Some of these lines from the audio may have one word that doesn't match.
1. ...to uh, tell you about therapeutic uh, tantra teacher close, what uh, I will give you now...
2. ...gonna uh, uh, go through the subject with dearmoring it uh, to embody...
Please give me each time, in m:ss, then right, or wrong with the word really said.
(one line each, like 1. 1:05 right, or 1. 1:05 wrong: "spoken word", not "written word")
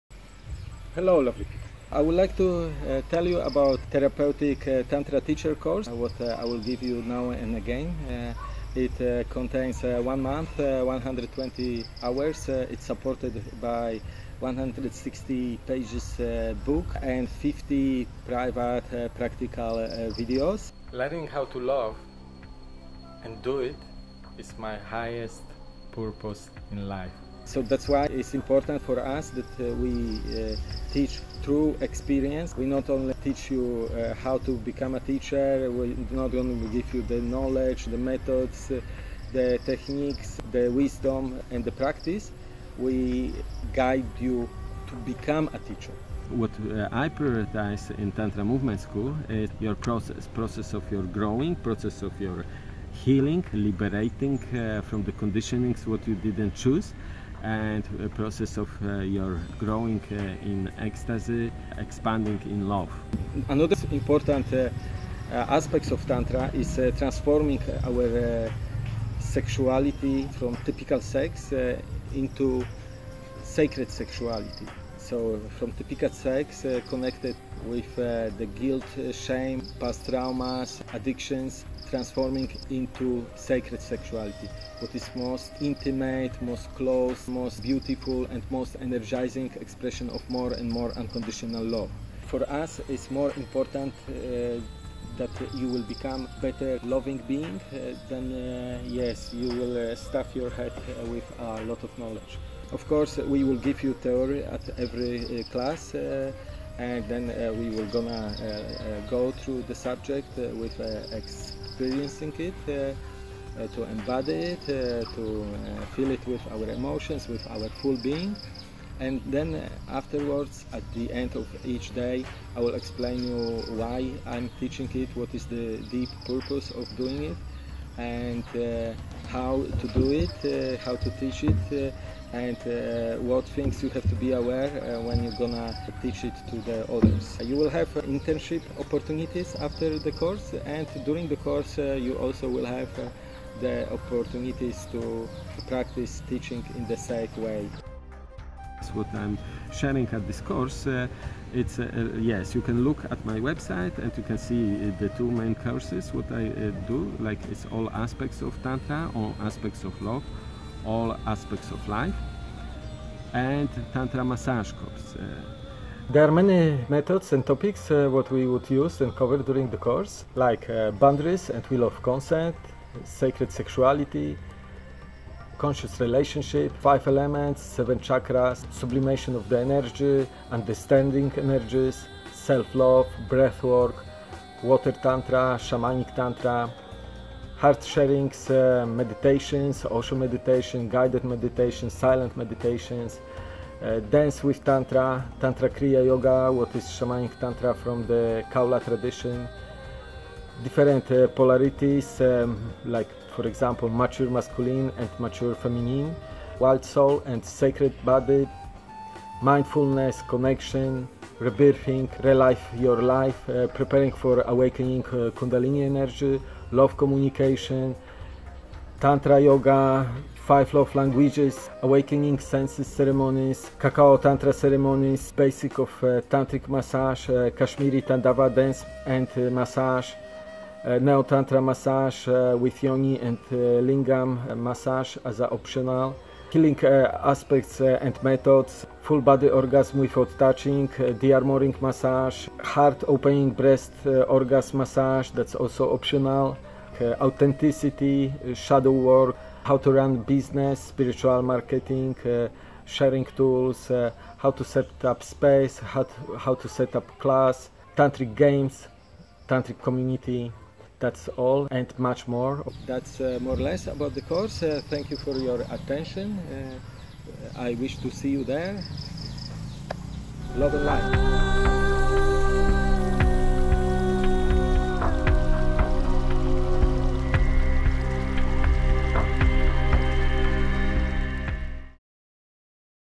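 1. 0:02 wrong: "course", not "close"
2. 1:47 wrong: "experiencing", not "dearmoring".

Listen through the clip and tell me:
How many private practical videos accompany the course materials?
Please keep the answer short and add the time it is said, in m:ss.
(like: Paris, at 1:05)
50, at 0:17.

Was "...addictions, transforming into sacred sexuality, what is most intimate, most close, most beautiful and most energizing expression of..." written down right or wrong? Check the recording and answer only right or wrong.
right.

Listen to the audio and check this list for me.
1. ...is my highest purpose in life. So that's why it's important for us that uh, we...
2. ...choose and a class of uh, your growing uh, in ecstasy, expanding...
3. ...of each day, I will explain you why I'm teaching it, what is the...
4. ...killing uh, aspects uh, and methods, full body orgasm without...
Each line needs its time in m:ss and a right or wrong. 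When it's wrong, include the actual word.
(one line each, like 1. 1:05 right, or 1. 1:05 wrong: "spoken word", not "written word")
1. 0:24 right
2. 0:56 wrong: "process", not "class"
3. 2:01 right
4. 3:56 right.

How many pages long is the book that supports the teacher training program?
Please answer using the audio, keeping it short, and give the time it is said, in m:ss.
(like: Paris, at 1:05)
160, at 0:14.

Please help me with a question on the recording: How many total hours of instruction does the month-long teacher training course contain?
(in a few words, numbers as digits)
120.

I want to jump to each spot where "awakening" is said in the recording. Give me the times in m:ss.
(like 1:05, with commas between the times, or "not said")
3:34, 3:41.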